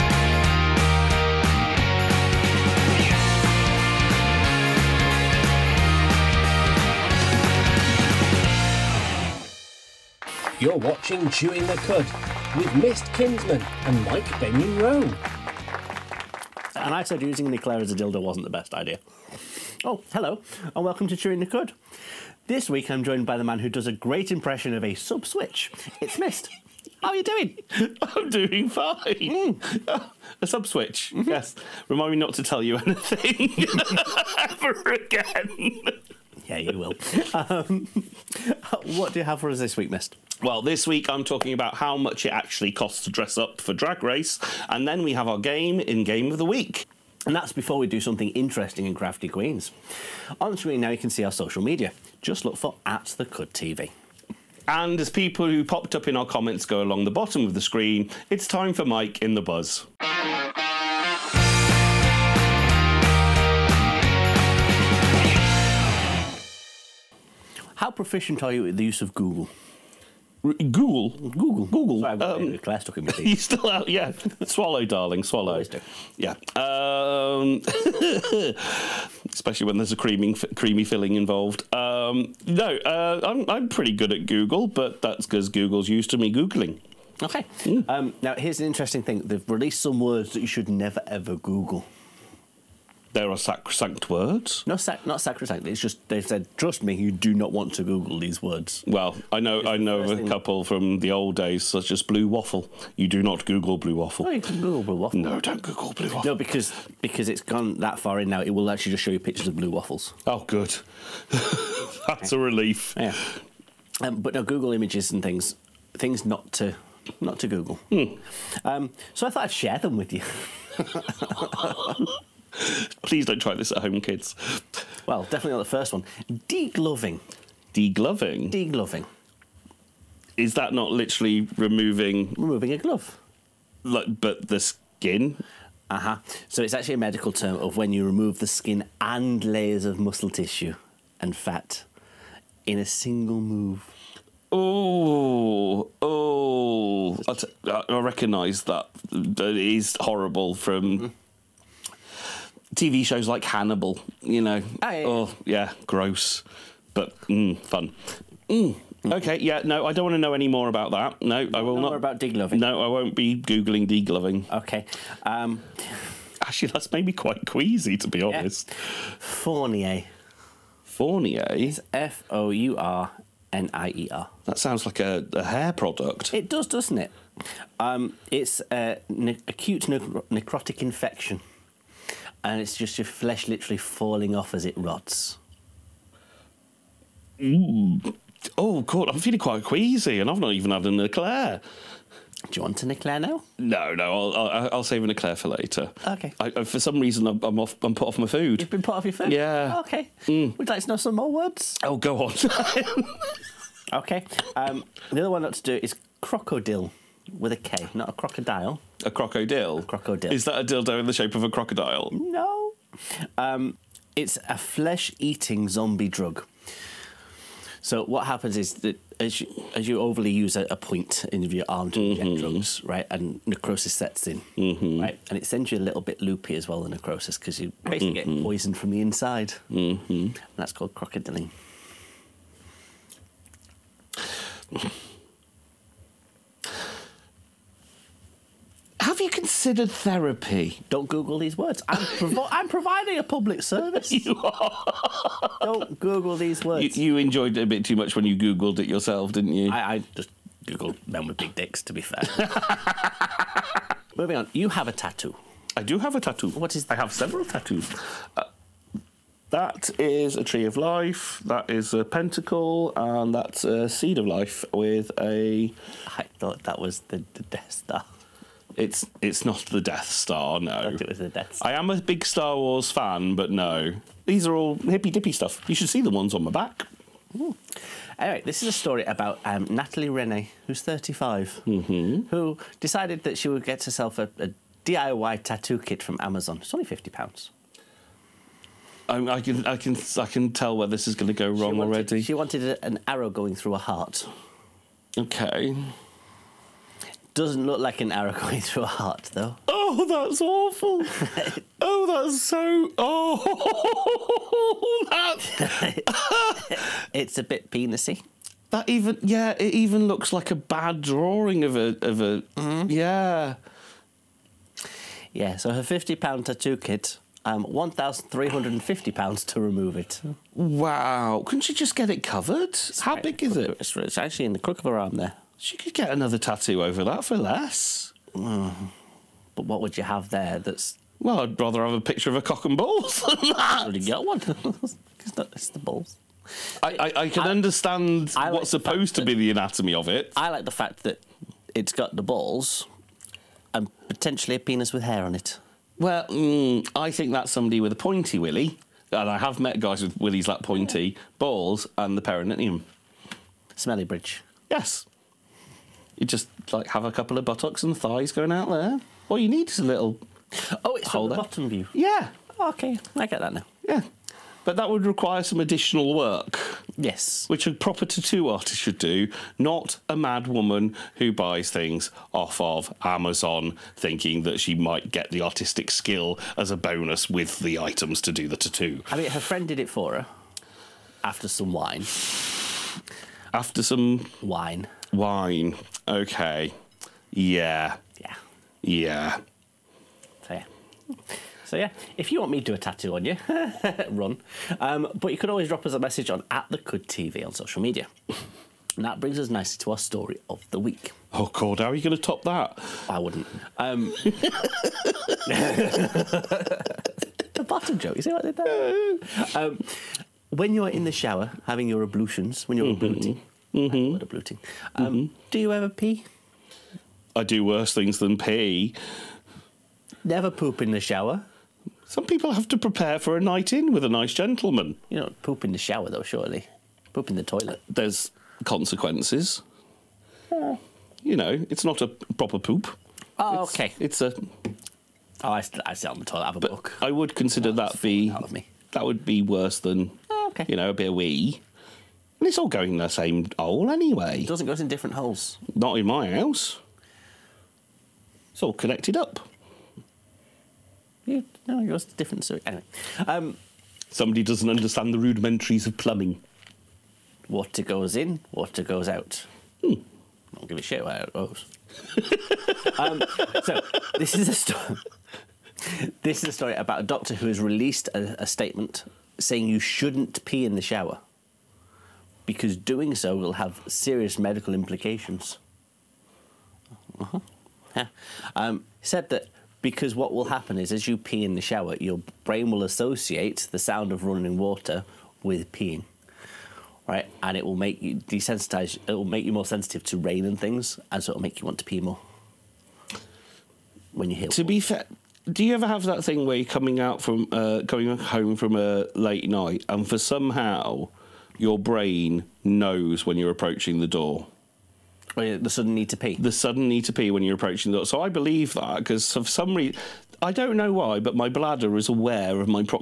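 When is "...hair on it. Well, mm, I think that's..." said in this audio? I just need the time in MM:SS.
05:45.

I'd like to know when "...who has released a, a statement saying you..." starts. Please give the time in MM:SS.
07:47.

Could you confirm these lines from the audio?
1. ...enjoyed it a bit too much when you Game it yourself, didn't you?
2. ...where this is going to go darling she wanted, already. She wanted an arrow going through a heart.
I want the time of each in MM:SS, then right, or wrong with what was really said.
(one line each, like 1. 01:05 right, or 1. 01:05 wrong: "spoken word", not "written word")
1. 04:07 wrong: "Googled", not "Game"
2. 04:50 wrong: "wrong", not "darling".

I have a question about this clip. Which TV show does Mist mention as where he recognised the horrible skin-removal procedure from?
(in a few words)
Hannibal.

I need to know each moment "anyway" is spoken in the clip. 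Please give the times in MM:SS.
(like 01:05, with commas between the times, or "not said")
04:38, 07:23, 07:32.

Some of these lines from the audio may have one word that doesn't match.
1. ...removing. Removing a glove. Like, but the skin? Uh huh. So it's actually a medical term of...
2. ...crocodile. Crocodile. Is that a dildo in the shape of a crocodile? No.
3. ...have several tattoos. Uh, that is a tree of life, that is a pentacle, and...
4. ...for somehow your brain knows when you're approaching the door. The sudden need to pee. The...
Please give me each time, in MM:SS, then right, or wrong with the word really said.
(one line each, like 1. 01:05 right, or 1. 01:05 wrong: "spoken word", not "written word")
1. 02:11 right
2. 03:29 right
3. 04:17 right
4. 08:20 right.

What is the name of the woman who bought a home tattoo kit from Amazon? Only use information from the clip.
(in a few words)
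Natalie Rene.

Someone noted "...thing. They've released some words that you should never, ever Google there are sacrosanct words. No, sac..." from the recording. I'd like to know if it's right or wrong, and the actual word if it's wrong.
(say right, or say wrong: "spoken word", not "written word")
right.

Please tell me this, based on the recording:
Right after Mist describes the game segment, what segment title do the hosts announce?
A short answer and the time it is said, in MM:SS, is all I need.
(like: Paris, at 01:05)
Crafty Queens, at 00:48.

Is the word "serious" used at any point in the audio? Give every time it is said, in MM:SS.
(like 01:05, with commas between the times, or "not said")
07:53.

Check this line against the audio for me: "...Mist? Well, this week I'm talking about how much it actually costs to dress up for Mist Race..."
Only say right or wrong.
wrong.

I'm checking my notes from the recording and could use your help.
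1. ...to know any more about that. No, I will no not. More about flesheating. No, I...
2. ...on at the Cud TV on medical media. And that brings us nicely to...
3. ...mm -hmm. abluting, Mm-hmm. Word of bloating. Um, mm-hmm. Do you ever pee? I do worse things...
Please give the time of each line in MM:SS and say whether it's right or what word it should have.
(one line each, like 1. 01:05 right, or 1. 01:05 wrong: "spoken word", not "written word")
1. 02:40 wrong: "degloving", not "flesheating"
2. 06:36 wrong: "social", not "medical"
3. 06:52 right.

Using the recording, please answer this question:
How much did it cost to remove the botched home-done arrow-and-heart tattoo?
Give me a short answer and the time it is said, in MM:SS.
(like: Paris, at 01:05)
£1,350, at 05:17.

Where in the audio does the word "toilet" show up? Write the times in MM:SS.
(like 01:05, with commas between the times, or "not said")
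07:07, 07:16.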